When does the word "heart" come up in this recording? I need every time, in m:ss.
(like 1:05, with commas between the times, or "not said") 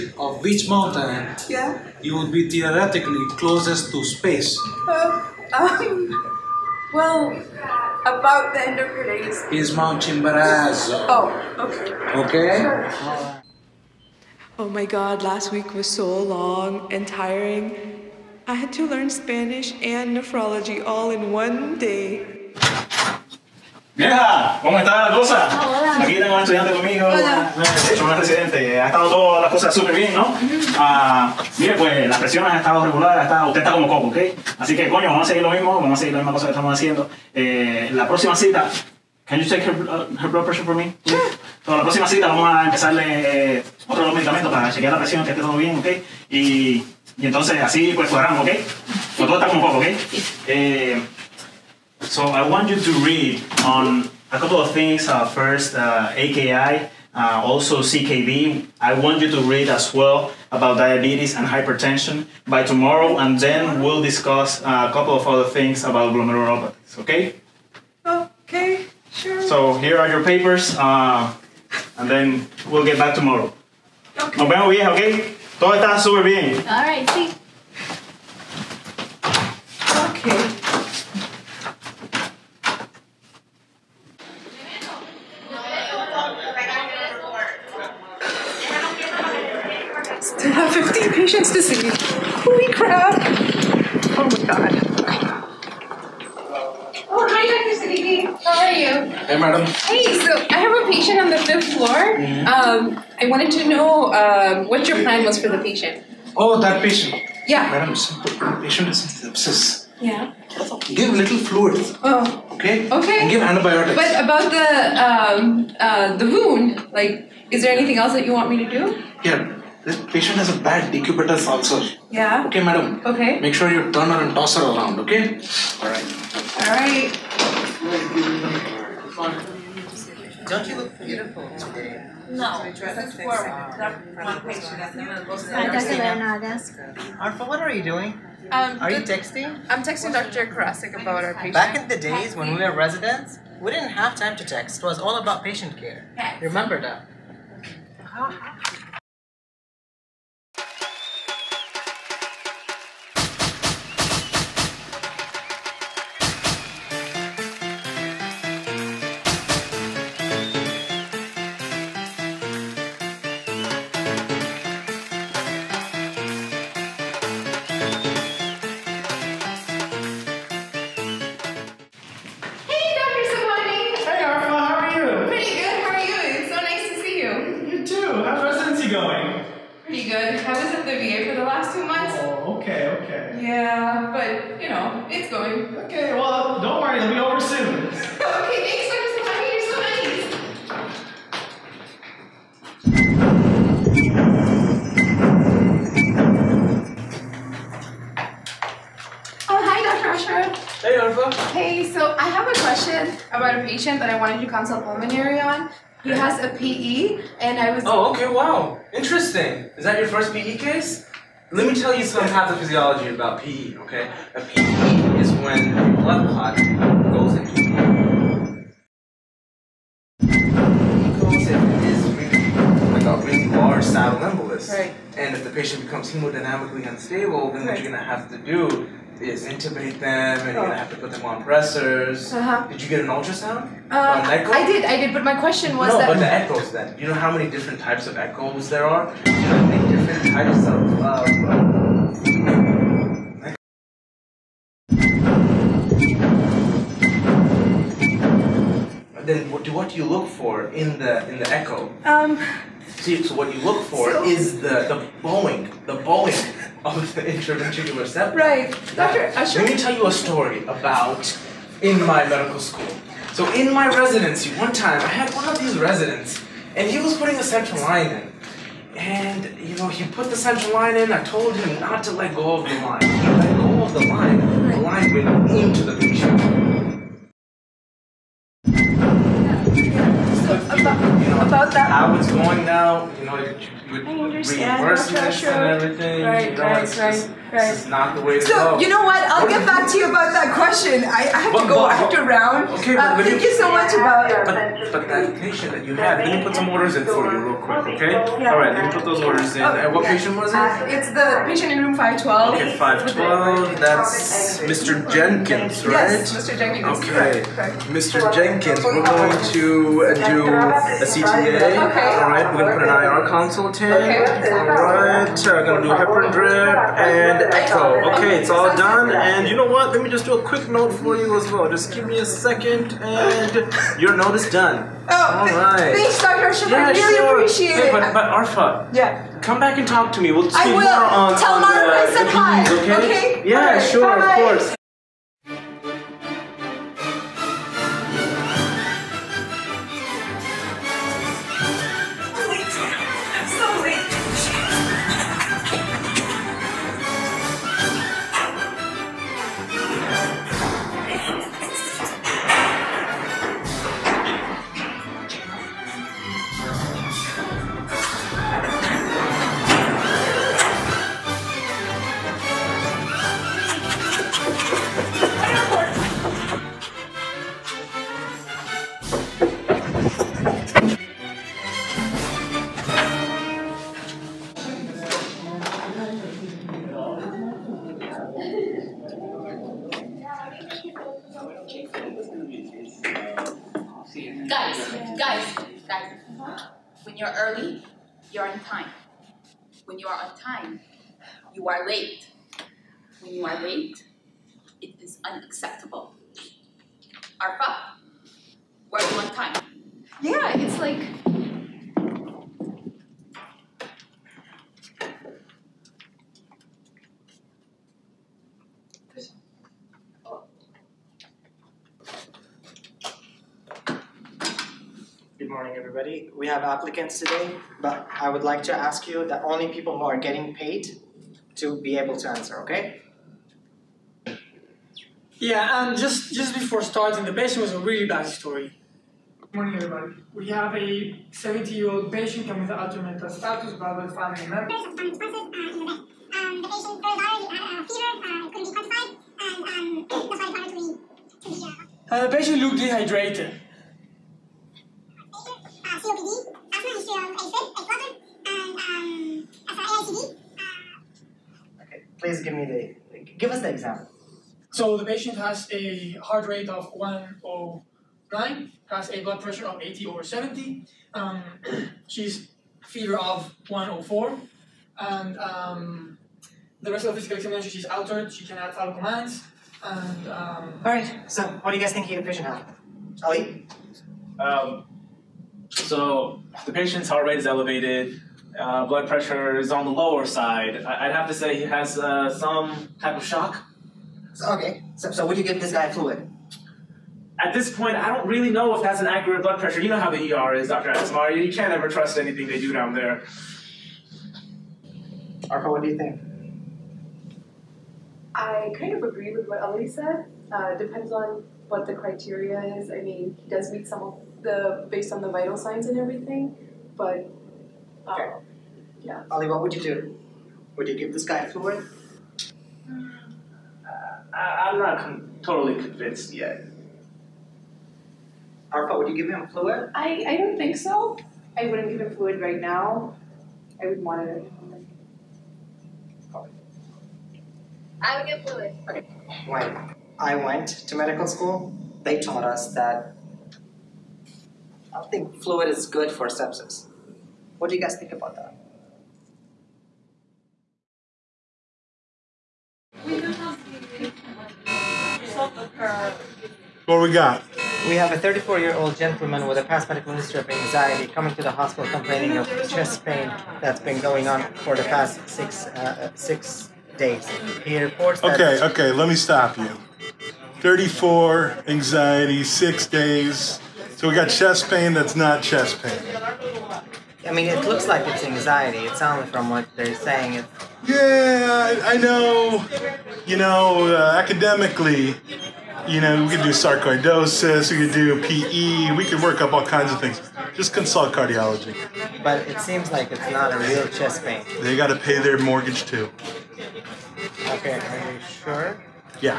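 7:36, 7:57.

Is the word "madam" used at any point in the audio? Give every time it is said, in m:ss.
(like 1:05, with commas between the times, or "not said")
1:47, 2:02.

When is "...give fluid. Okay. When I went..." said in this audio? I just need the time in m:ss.
8:48.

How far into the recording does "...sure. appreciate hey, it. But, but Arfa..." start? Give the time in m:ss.
5:27.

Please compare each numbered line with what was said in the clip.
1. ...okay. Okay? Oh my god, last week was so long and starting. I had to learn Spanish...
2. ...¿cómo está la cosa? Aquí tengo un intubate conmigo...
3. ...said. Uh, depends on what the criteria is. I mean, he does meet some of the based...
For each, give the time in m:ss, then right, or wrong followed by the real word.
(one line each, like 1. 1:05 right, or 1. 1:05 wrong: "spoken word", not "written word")
1. 0:11 wrong: "tiring", not "starting"
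2. 0:24 wrong: "estudiante", not "intubate"
3. 8:19 right.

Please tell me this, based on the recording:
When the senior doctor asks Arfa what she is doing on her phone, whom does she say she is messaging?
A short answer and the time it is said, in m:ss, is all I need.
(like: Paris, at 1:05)
Dr. Karasik, at 2:20.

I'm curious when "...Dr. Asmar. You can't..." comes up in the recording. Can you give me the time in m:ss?
8:10.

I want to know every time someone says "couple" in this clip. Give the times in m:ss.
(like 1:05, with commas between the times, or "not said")
0:54, 1:04.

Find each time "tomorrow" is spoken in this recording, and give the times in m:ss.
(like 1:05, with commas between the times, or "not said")
1:02, 1:13.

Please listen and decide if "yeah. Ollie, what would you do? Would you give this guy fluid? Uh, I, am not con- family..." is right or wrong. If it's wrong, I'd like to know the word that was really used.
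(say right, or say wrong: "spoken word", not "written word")
wrong: "totally", not "family".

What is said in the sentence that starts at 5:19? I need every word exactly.
Let me just do a quick note for you as well.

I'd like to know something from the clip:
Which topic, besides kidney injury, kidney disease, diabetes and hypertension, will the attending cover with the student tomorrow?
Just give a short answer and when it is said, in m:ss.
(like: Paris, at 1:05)
glomerulopathies, at 1:06.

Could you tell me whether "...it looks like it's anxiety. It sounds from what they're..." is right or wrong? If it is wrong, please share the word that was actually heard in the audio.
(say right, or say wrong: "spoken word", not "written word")
right.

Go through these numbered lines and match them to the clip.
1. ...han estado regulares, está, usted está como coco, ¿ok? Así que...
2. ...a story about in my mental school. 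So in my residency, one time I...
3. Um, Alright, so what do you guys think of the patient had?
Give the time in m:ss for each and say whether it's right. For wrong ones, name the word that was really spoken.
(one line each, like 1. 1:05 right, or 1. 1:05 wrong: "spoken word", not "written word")
1. 0:32 right
2. 4:20 wrong: "medical", not "mental"
3. 7:50 right.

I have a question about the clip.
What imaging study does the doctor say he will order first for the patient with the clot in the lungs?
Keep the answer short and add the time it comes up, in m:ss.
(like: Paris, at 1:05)
CTA, at 5:10.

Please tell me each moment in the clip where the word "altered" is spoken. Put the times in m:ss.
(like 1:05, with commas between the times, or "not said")
7:12, 7:47.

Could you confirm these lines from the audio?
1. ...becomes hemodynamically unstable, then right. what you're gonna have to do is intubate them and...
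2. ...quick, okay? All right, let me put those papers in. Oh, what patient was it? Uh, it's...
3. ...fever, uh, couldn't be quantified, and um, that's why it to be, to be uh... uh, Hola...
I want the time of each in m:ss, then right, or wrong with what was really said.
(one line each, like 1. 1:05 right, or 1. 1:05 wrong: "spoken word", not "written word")
1. 3:45 right
2. 4:57 wrong: "orders", not "papers"
3. 7:23 wrong: "The", not "Hola".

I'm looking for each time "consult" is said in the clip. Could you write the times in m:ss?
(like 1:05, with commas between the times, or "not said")
3:24, 5:13, 9:40.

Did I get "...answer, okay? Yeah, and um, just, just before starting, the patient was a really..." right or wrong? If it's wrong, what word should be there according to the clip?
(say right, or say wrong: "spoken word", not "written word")
right.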